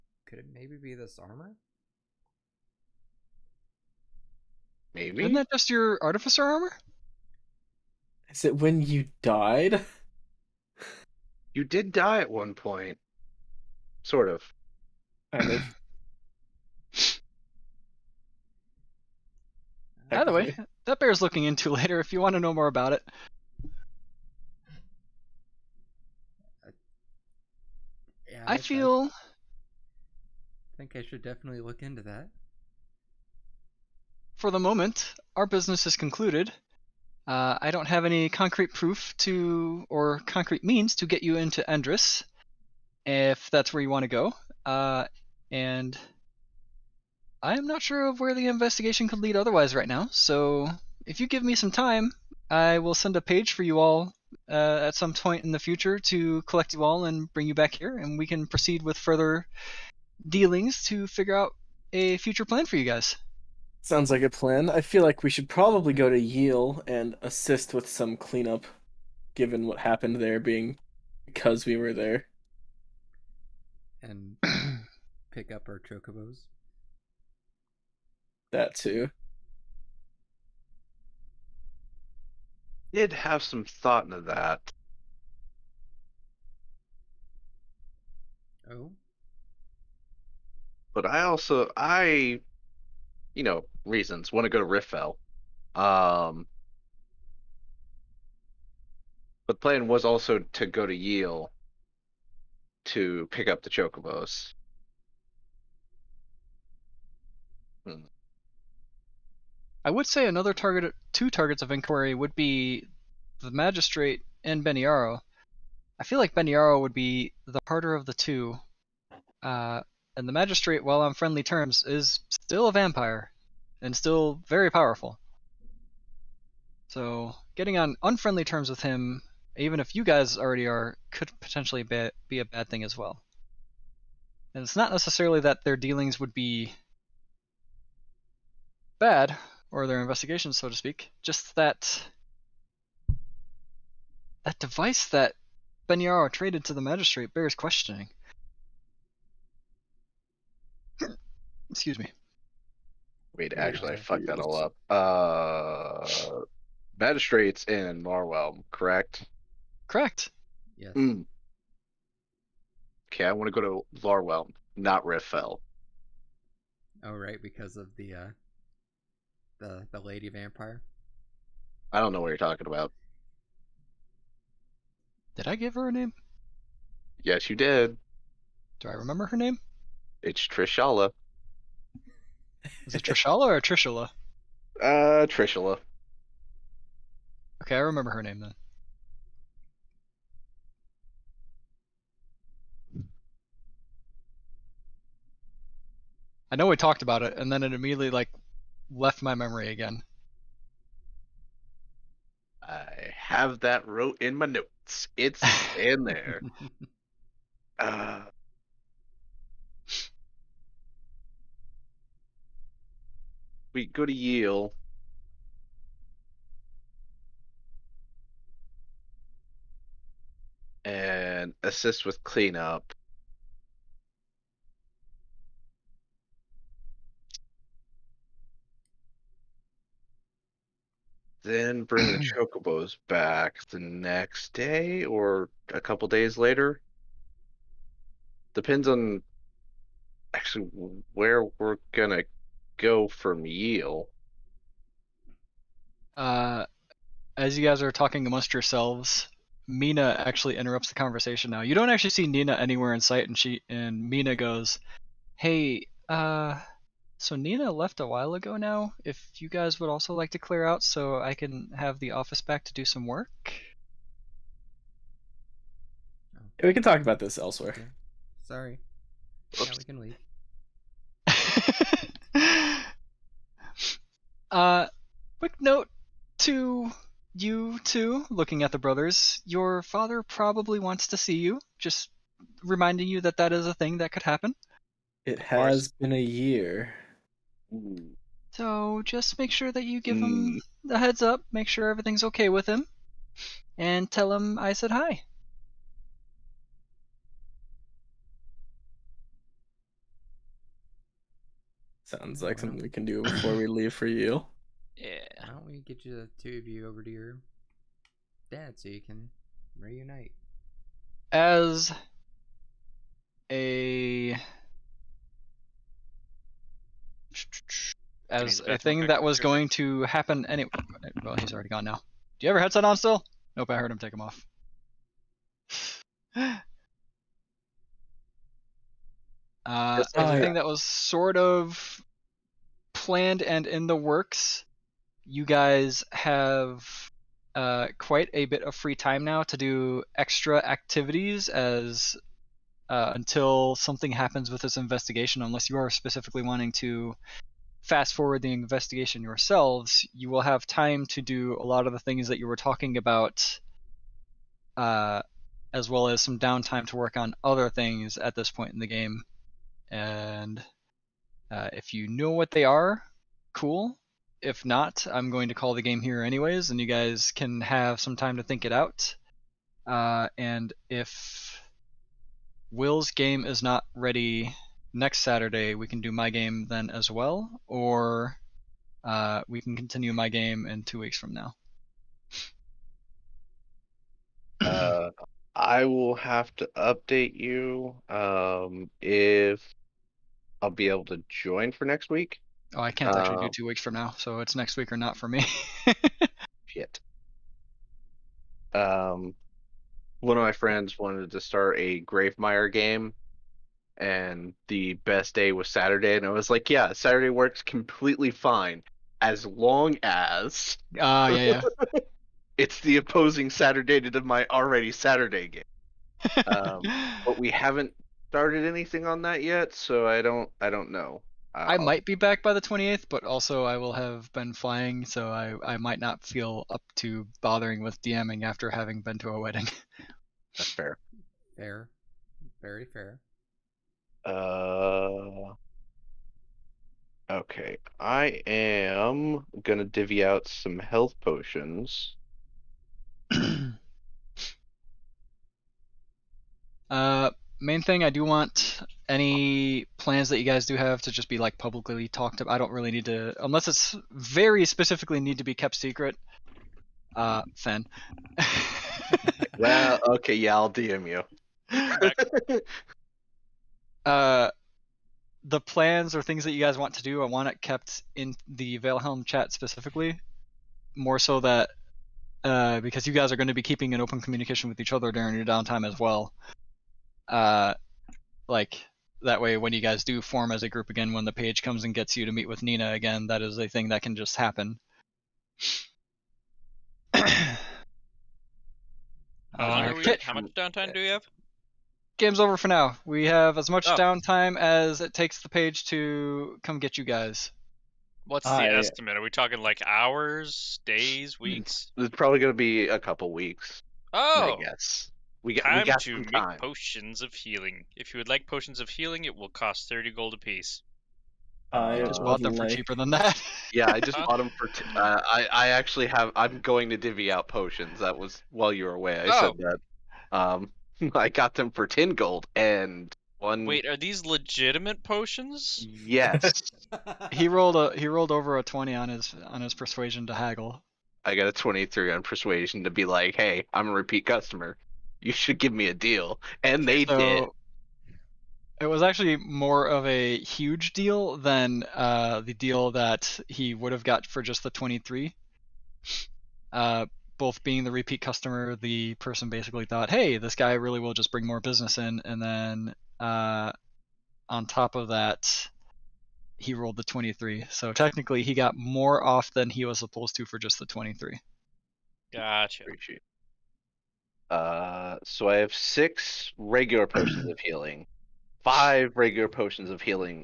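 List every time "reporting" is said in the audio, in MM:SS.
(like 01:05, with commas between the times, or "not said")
not said.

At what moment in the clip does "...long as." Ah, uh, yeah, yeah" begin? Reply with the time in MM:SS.
06:49.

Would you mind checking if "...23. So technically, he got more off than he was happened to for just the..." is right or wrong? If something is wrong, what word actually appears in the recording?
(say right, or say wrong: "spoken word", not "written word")
wrong: "supposed", not "happened".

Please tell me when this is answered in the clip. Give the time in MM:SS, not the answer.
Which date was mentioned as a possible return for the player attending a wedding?
07:02.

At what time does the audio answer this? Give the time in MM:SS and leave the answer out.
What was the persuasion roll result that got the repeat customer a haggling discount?
08:51.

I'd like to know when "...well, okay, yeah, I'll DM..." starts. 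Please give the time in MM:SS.
07:39.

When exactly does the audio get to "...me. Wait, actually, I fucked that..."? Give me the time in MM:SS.
02:31.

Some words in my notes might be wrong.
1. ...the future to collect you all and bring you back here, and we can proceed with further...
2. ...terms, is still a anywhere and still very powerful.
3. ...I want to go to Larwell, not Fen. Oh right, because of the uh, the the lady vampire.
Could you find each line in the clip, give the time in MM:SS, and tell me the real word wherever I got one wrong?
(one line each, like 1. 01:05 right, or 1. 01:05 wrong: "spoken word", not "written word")
1. 00:55 right
2. 02:01 wrong: "vampire", not "anywhere"
3. 02:43 wrong: "Riftfell", not "Fen".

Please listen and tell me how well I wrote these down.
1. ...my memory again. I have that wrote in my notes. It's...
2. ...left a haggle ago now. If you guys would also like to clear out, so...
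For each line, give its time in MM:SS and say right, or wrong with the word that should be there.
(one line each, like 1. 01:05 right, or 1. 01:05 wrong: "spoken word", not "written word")
1. 03:19 right
2. 04:17 wrong: "while", not "haggle".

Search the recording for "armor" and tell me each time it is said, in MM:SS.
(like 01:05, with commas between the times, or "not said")
00:01, 00:06.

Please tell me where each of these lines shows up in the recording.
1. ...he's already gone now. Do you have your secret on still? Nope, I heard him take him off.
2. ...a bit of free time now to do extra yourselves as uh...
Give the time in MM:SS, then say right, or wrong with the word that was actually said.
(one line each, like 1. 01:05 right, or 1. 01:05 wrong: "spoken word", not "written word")
1. 05:21 wrong: "headset", not "secret"
2. 05:38 wrong: "activities", not "yourselves".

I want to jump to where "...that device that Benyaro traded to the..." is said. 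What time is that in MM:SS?
02:24.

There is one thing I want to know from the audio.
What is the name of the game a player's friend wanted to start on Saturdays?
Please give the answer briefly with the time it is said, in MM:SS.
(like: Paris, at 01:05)
Gravemire, at 06:42.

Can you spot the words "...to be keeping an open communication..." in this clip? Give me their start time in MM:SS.
07:53.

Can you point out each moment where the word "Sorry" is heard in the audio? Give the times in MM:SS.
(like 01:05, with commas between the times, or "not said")
04:28.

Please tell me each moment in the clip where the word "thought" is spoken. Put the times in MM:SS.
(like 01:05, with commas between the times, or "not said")
01:23, 09:09.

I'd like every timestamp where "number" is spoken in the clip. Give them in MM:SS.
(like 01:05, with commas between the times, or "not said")
not said.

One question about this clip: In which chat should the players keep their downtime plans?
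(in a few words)
Valehelm chat.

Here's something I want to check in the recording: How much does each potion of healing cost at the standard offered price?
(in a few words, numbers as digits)
30 gold.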